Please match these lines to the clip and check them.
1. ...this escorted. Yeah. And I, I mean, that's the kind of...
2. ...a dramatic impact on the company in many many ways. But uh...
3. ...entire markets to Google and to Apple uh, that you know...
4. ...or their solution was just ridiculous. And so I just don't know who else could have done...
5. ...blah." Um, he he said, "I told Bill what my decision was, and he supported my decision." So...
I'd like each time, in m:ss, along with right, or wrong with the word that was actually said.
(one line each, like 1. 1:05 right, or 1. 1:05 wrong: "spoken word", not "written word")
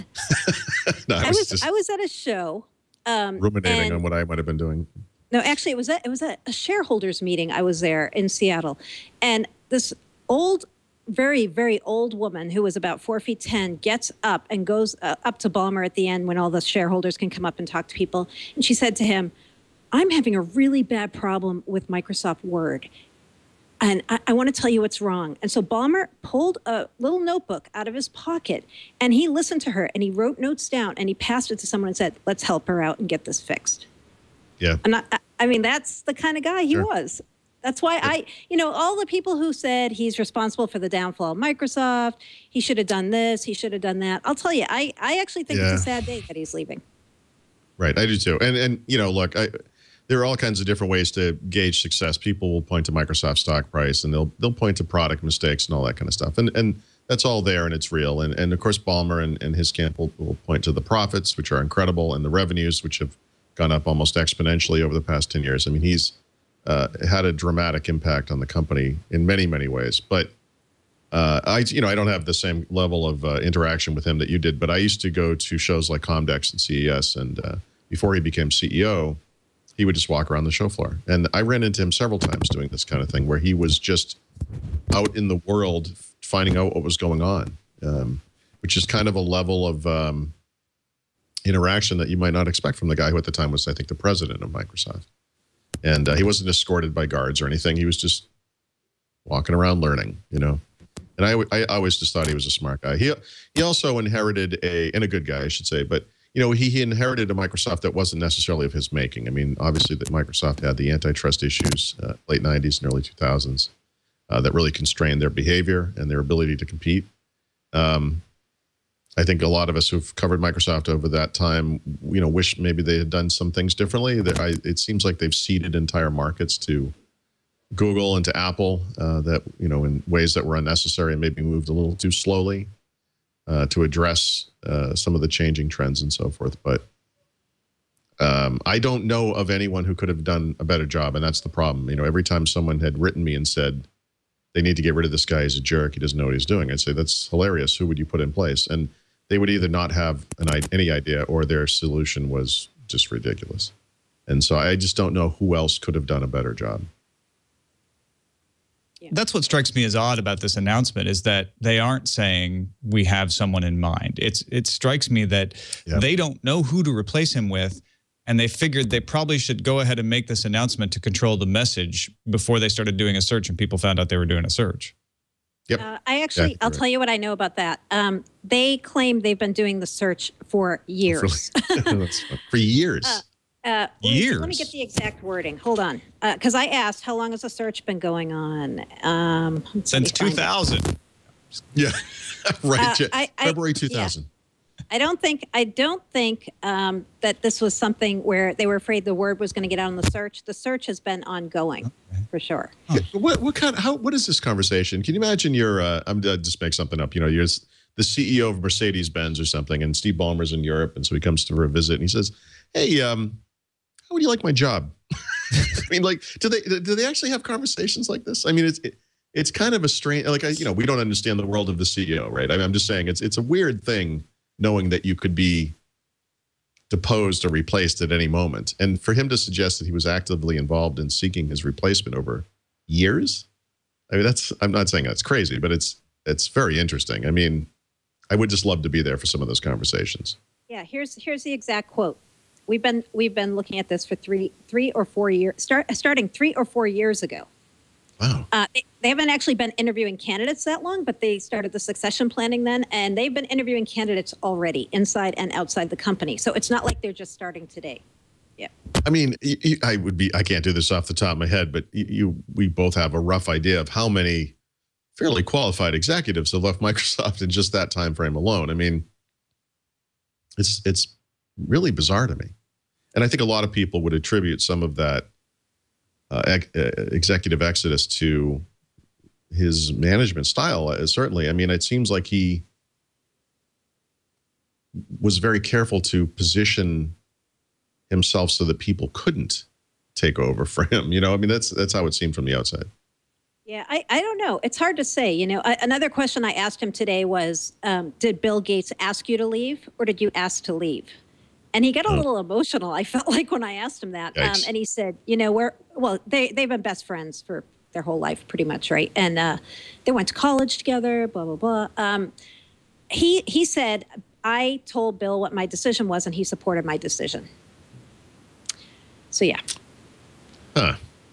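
1. 0:33 wrong: "fixed", not "escorted"
2. 1:07 right
3. 2:05 right
4. 2:31 right
5. 5:11 right.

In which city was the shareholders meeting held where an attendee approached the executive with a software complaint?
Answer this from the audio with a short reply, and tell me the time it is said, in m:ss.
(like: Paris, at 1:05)
Seattle, at 0:08.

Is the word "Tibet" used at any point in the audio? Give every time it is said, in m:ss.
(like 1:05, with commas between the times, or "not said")
not said.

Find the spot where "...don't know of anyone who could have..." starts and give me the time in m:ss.
2:18.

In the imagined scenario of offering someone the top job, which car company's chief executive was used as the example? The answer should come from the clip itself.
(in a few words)
Mercedes Benz.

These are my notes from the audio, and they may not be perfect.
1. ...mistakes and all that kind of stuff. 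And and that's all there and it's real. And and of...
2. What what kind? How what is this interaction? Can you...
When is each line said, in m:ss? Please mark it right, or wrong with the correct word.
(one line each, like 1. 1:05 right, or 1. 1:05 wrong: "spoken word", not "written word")
1. 0:55 right
2. 3:23 wrong: "conversation", not "interaction".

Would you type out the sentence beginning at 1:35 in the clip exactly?
And uh, he wasn't escorted by guards or anything.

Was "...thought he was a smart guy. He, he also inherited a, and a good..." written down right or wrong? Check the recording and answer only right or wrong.
right.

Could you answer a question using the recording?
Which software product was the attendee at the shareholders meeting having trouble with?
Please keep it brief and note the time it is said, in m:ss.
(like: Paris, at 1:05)
Microsoft Word, at 0:21.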